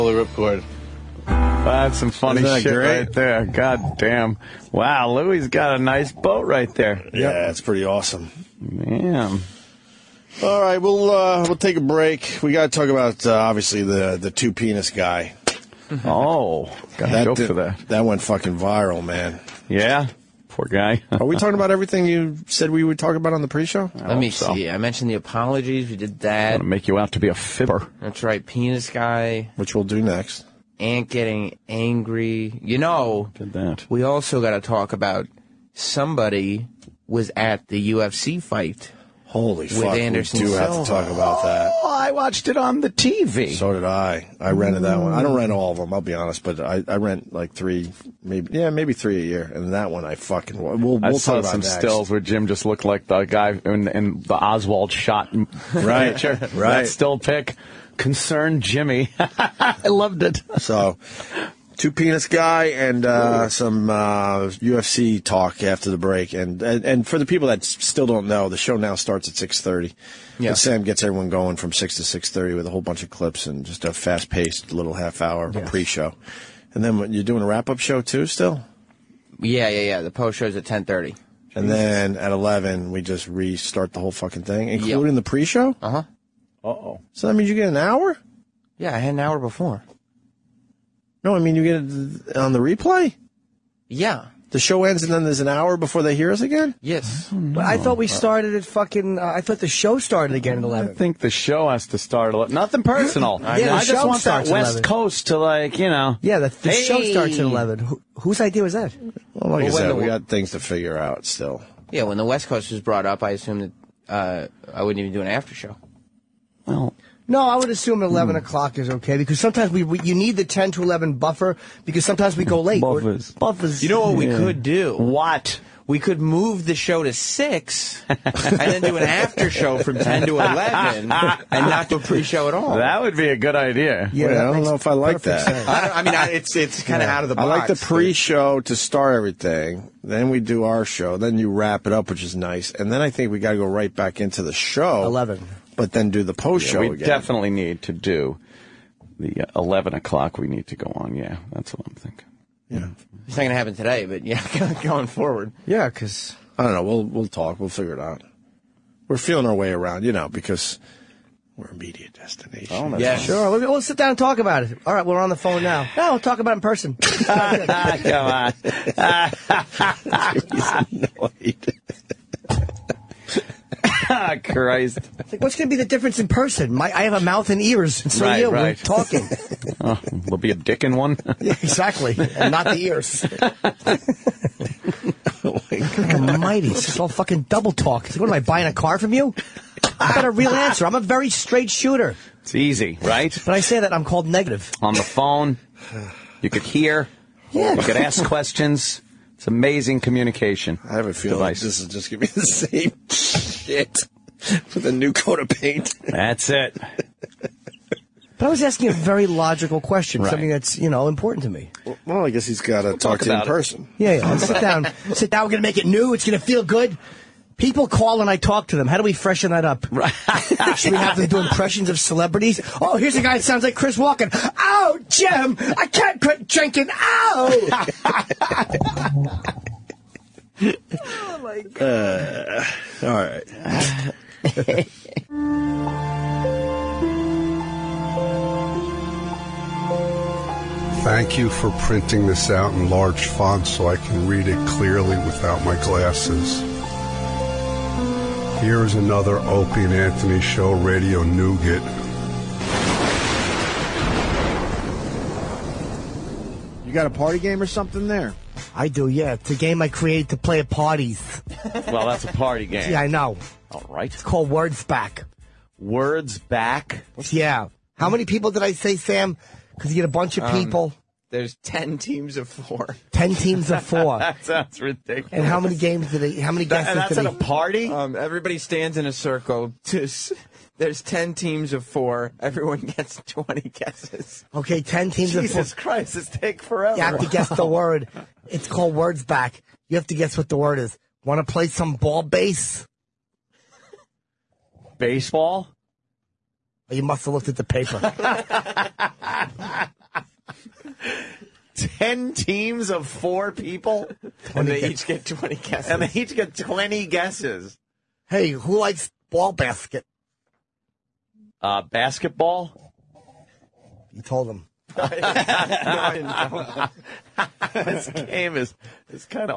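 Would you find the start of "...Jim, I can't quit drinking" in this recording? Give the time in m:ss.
3:45.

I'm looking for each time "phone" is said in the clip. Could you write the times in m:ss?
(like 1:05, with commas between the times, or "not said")
2:45, 3:15.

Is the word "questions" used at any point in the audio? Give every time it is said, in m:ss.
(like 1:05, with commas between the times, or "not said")
3:18, 3:29.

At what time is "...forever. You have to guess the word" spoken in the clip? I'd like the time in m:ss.
4:46.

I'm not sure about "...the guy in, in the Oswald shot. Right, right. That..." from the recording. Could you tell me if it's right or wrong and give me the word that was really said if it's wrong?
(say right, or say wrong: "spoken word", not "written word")
right.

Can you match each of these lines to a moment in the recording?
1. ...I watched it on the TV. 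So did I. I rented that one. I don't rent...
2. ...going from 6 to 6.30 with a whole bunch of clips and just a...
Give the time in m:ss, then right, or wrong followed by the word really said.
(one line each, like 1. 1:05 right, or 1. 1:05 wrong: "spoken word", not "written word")
1. 0:41 right
2. 1:11 right.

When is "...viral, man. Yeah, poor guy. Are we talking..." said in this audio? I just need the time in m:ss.
0:18.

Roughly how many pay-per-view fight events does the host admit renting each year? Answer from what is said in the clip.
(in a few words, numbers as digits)
3.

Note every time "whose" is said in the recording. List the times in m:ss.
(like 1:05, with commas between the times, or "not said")
1:48.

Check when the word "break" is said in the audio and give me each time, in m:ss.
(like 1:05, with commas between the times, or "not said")
0:11, 1:05.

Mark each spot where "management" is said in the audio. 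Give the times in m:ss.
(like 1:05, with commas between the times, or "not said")
not said.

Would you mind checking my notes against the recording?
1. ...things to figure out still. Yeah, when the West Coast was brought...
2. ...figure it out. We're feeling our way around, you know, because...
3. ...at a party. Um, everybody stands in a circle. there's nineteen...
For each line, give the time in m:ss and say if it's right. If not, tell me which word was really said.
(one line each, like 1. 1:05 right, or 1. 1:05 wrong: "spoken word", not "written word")
1. 1:50 right
2. 2:37 right
3. 4:37 wrong: "ten", not "nineteen".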